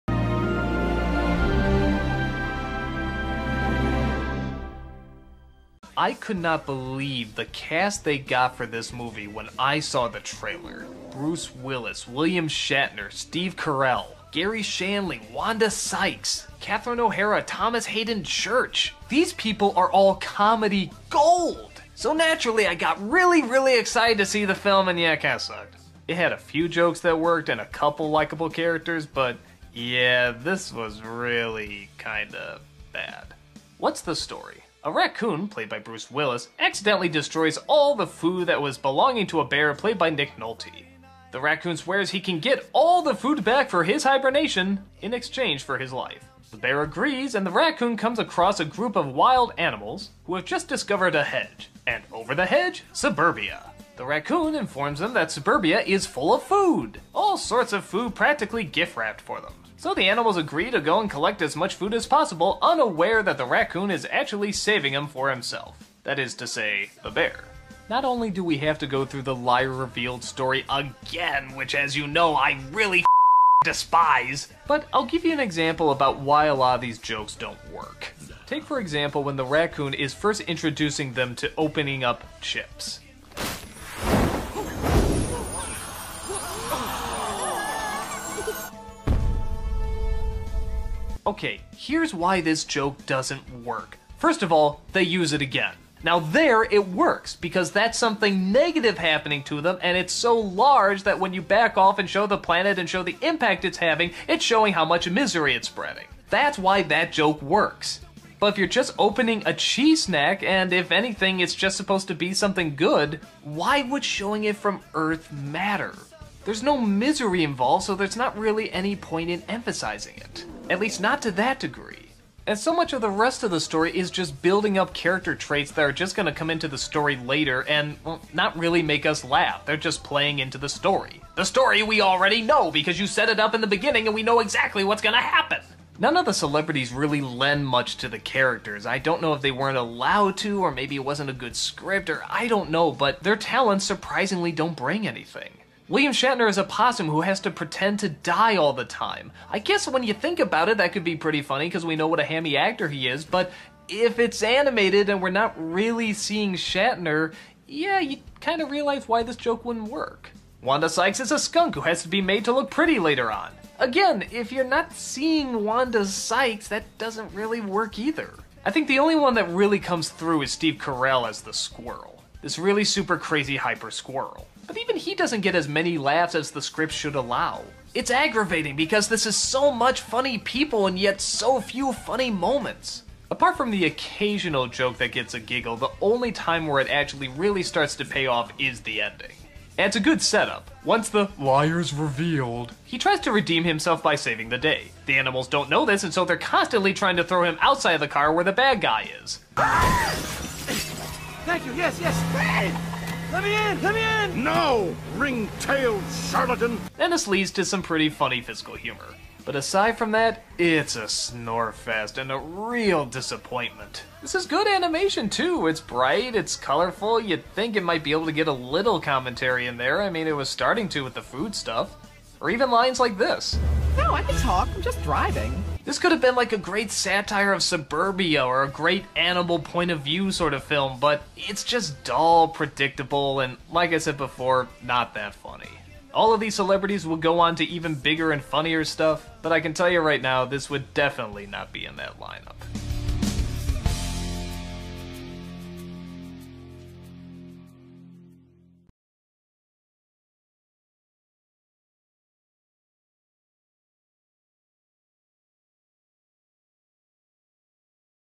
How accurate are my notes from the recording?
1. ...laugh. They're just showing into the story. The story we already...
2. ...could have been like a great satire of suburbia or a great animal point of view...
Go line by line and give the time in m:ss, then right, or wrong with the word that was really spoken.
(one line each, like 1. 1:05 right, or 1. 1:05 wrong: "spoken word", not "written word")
1. 2:09 wrong: "playing", not "showing"
2. 3:45 right.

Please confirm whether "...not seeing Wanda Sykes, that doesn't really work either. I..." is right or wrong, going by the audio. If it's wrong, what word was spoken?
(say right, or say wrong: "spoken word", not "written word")
right.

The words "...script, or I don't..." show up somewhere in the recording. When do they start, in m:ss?
2:21.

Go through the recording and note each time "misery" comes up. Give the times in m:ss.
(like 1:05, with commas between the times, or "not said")
1:45, 1:56.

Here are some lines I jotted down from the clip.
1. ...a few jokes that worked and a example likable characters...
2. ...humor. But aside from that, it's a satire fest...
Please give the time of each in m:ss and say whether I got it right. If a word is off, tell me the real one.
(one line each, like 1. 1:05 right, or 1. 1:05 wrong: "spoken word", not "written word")
1. 0:26 wrong: "couple", not "example"
2. 3:28 wrong: "snore", not "satire".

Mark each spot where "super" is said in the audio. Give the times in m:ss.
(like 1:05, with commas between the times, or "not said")
2:52.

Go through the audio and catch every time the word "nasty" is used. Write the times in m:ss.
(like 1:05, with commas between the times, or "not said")
not said.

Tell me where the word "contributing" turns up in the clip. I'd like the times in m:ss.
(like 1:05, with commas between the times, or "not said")
not said.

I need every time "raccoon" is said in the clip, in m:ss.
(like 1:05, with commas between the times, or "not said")
0:34, 0:41, 0:47, 0:54, 1:03, 1:19.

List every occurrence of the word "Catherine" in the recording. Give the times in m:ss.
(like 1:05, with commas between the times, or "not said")
0:16.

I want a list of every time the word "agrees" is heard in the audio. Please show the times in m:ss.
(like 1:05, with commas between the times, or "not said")
0:46, 1:00.